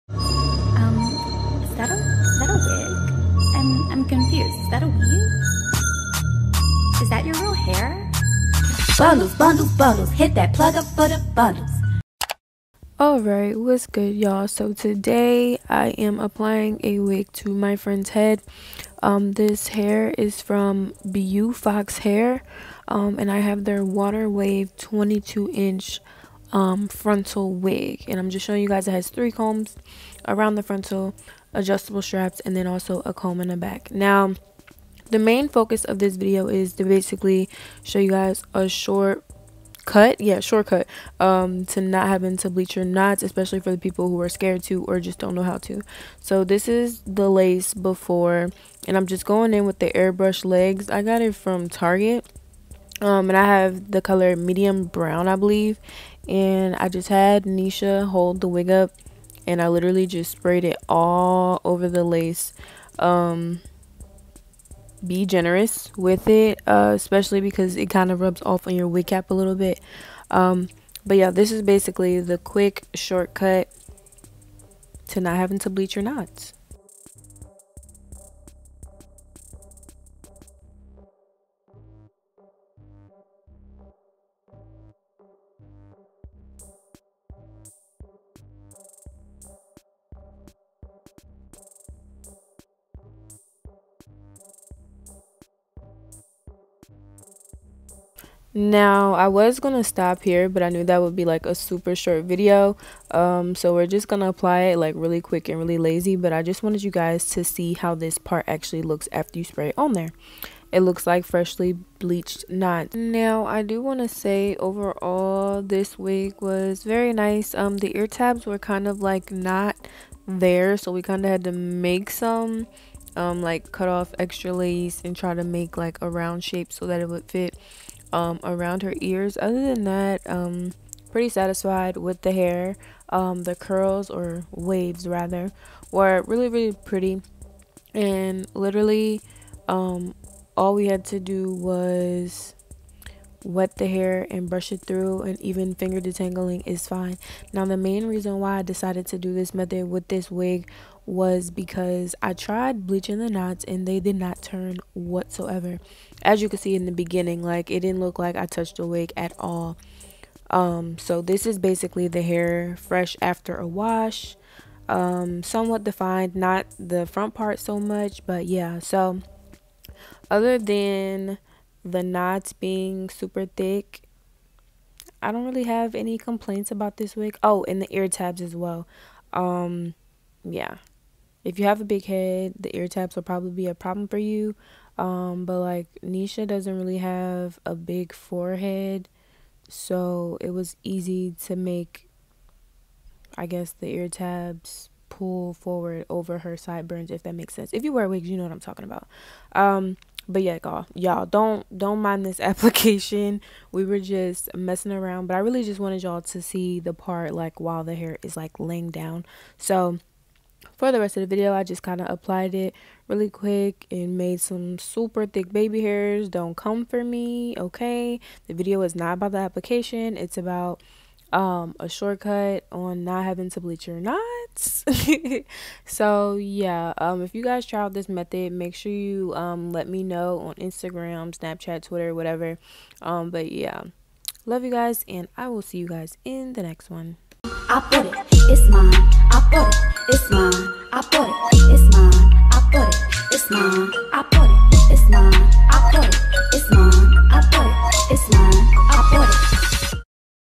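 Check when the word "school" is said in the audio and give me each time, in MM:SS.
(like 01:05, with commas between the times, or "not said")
not said.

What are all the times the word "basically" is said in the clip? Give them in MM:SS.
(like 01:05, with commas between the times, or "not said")
00:36, 01:11, 02:41.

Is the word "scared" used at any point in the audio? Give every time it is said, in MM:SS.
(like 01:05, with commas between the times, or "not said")
00:44.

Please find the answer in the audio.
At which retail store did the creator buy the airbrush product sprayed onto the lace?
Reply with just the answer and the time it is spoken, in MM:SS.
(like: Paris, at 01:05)
Target, at 00:51.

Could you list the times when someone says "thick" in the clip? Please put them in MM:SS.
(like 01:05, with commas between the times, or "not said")
02:53, 03:35.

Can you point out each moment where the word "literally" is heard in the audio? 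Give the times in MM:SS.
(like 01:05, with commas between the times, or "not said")
00:59, 02:18.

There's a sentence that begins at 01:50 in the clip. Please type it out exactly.
It looks like freshly bleached knots.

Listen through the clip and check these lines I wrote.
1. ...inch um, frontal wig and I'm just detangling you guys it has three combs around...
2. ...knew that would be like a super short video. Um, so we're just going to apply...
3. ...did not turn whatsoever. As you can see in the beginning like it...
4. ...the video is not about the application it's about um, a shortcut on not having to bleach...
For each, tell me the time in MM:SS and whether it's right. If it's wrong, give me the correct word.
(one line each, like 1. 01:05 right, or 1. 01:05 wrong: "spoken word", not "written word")
1. 00:25 wrong: "showing", not "detangling"
2. 01:40 right
3. 02:33 right
4. 03:38 right.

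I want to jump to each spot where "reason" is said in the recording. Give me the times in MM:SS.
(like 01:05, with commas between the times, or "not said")
02:28.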